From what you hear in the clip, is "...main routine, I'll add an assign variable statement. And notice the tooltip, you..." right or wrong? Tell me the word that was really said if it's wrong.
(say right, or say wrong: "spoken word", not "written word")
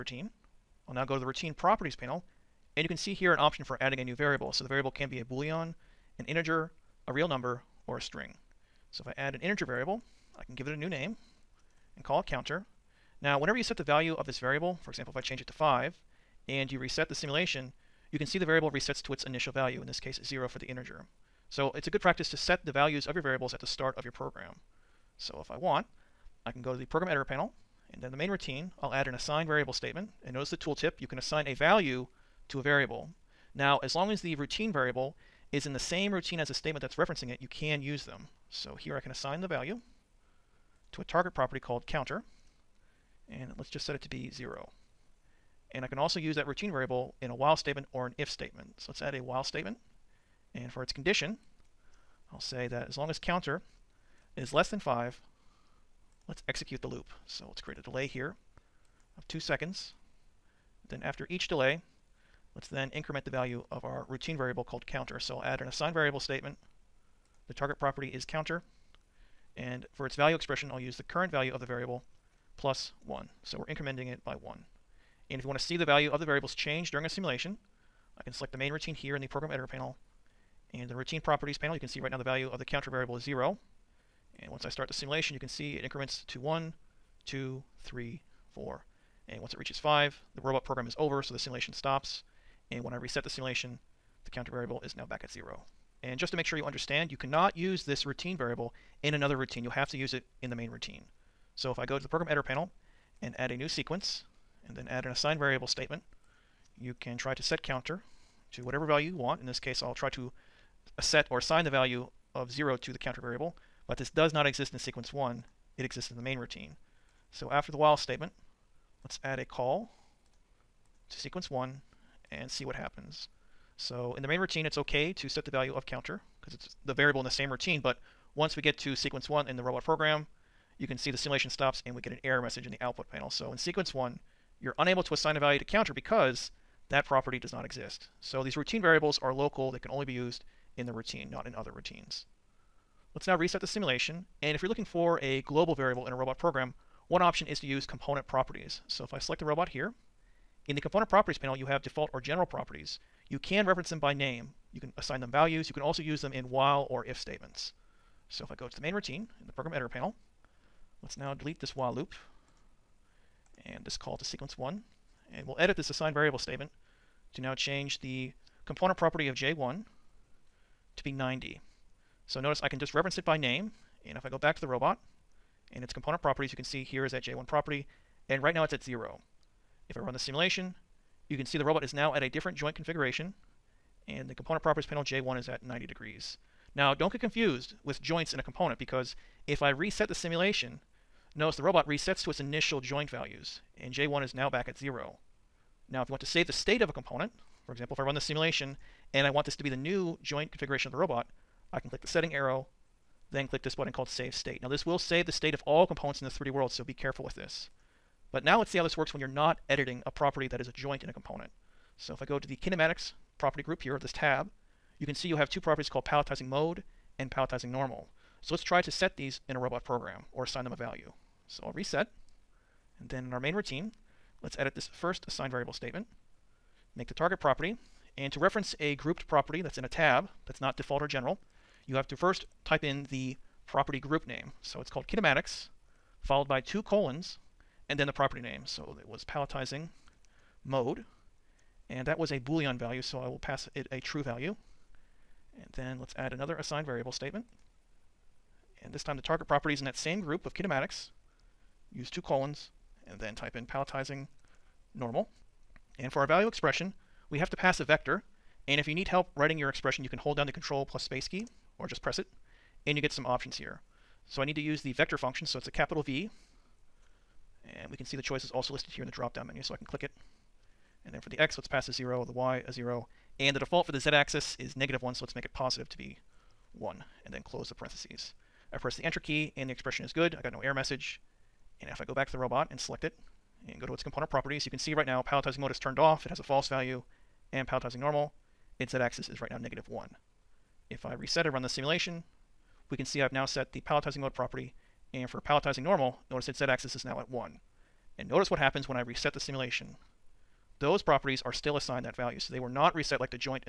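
right.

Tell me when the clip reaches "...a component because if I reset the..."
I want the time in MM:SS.
03:08.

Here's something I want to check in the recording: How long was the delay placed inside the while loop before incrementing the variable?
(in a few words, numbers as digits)
2 seconds.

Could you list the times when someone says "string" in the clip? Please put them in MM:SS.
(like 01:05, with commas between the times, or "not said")
00:08.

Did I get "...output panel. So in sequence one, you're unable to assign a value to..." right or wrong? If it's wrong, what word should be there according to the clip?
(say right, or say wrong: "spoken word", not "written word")
right.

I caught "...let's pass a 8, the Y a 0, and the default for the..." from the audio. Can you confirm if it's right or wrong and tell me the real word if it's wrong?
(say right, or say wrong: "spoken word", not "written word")
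wrong: "0", not "8".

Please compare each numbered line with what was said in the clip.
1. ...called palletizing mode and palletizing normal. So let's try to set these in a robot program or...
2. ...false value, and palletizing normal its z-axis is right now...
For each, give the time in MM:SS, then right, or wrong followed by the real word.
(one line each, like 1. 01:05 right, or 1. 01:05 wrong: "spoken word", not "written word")
1. 03:35 right
2. 04:46 right.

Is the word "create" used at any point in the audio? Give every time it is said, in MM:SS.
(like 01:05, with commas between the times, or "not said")
00:57.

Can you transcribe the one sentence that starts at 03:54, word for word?
So it's called kinematics, followed by two colons, and then the property name.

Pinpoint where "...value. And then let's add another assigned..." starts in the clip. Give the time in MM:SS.
04:04.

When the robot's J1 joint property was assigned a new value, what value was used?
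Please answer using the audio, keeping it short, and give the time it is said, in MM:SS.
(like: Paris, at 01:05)
90, at 02:51.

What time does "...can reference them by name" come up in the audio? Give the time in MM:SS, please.
02:33.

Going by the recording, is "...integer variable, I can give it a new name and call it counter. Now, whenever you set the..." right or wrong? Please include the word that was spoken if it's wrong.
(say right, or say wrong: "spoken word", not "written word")
right.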